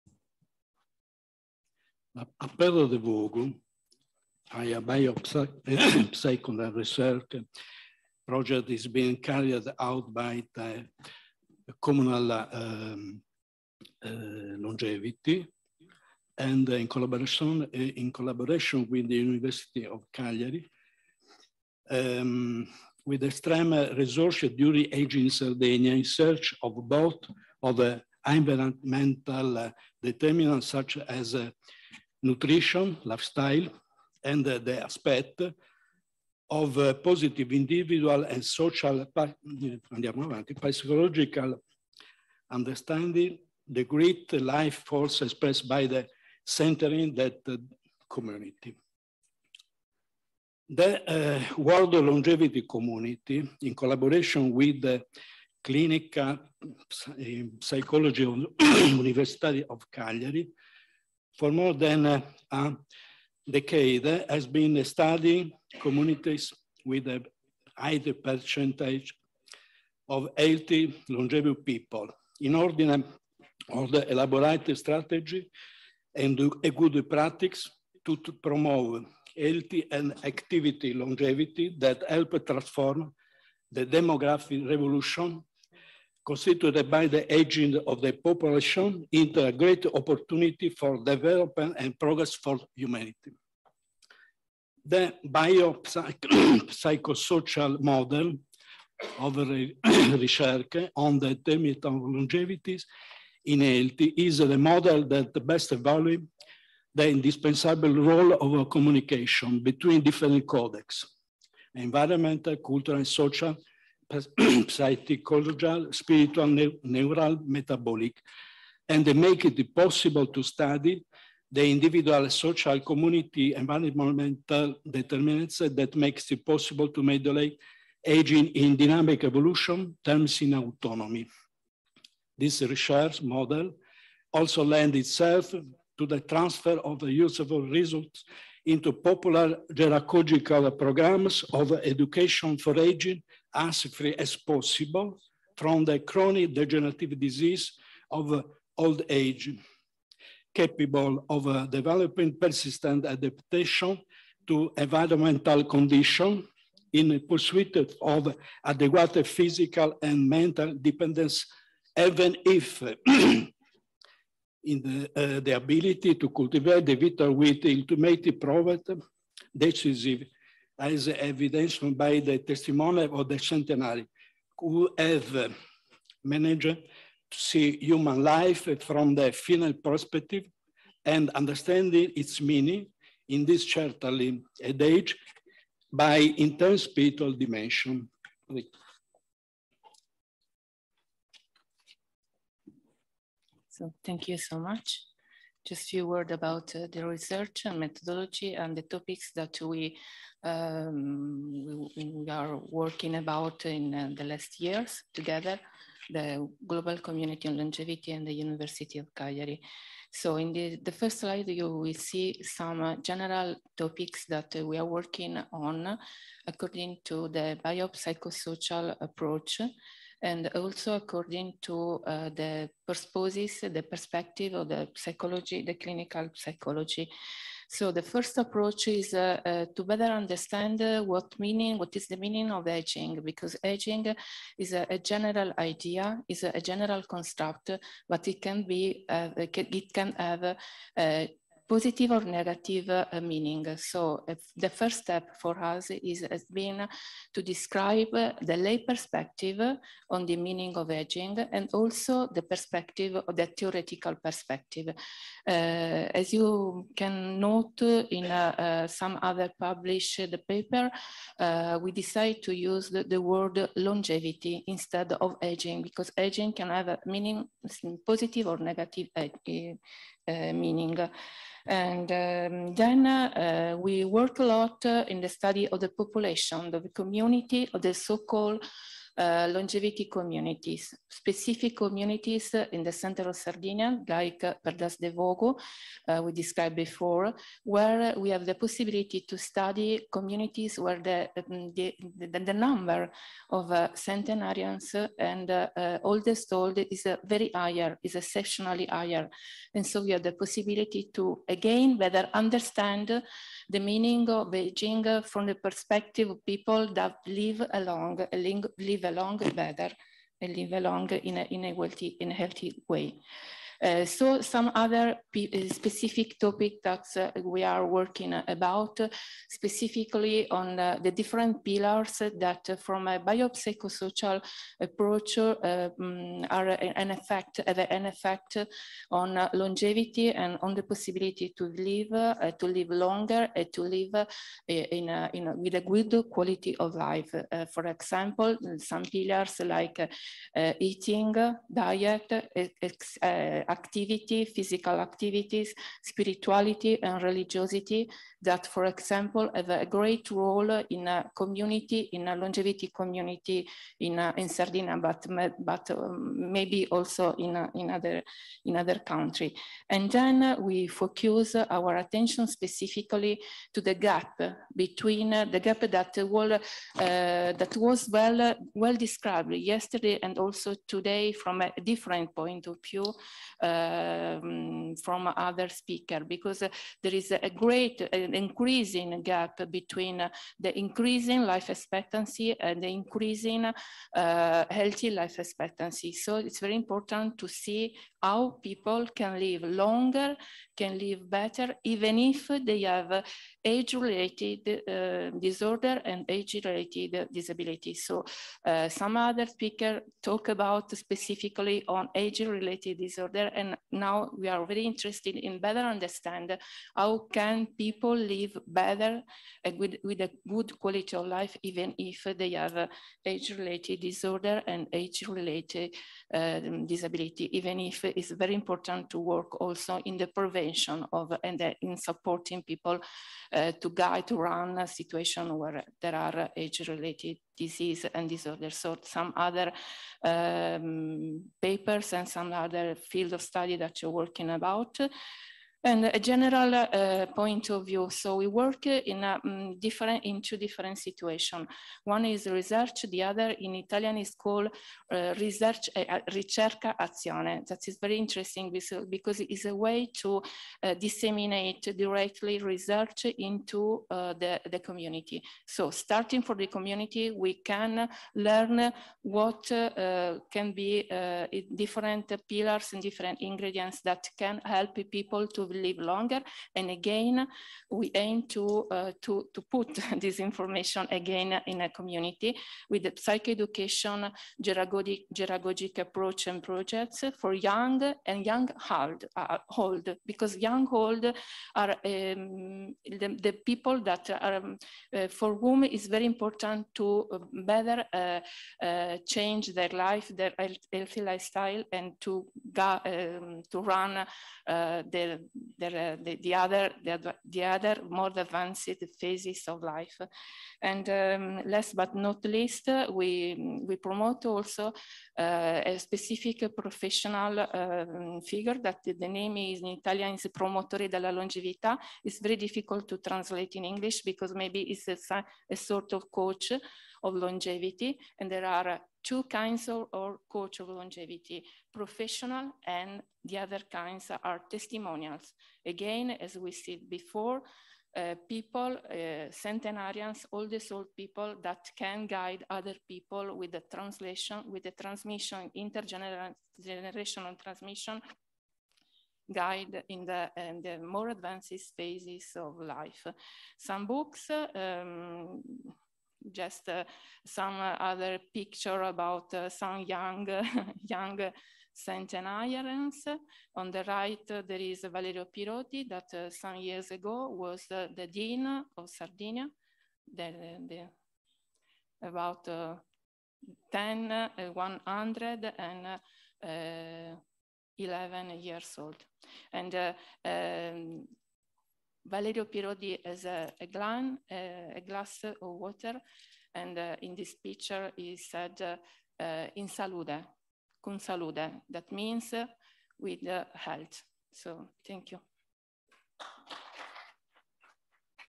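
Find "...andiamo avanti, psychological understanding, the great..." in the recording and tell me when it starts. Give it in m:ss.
0:39.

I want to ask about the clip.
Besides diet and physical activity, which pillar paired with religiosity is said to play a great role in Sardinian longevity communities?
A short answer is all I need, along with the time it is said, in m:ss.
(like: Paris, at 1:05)
spirituality, at 5:46.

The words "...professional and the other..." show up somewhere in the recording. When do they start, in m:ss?
8:41.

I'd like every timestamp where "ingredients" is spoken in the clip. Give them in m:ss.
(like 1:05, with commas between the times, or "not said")
7:43.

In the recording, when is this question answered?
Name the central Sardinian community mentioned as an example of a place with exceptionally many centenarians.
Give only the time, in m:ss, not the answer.
4:44.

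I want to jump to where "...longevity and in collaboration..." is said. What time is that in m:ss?
0:14.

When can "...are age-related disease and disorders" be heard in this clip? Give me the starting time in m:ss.
7:06.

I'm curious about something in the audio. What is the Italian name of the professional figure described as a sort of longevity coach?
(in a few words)
Promotore della Longevità.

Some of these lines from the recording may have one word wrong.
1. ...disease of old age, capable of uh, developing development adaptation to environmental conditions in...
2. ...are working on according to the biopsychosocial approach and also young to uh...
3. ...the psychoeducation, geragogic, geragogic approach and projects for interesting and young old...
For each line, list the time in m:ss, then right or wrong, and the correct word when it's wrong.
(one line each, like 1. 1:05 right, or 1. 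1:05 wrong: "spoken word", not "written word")
1. 2:27 wrong: "persistent", not "development"
2. 3:34 wrong: "according", not "young"
3. 7:53 wrong: "young", not "interesting".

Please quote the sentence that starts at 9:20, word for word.
The, the, about 10, uh, 100, and uh, 11 years old.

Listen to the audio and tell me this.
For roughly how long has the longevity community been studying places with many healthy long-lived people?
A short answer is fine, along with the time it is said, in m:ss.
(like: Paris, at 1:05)
a decade, at 1:03.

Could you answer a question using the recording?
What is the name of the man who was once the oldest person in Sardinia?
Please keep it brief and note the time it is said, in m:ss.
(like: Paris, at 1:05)
Valerio Pirotti, at 9:15.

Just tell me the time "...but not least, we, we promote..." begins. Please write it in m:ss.
8:21.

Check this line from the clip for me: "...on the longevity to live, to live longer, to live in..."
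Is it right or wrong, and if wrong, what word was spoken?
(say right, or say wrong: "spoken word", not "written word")
wrong: "possibility", not "longevity".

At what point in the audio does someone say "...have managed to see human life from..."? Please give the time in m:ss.
2:54.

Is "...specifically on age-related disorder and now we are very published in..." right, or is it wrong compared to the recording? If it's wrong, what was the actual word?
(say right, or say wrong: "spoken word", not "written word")
wrong: "interested", not "published".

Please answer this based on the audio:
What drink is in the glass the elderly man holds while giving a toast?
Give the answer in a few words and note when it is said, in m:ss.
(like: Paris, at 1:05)
water, at 9:35.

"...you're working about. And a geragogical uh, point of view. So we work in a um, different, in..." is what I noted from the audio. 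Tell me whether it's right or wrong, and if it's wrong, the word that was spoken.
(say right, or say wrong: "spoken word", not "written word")
wrong: "general", not "geragogical".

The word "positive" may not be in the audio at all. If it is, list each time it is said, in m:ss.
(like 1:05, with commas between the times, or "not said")
0:36, 4:01, 4:28.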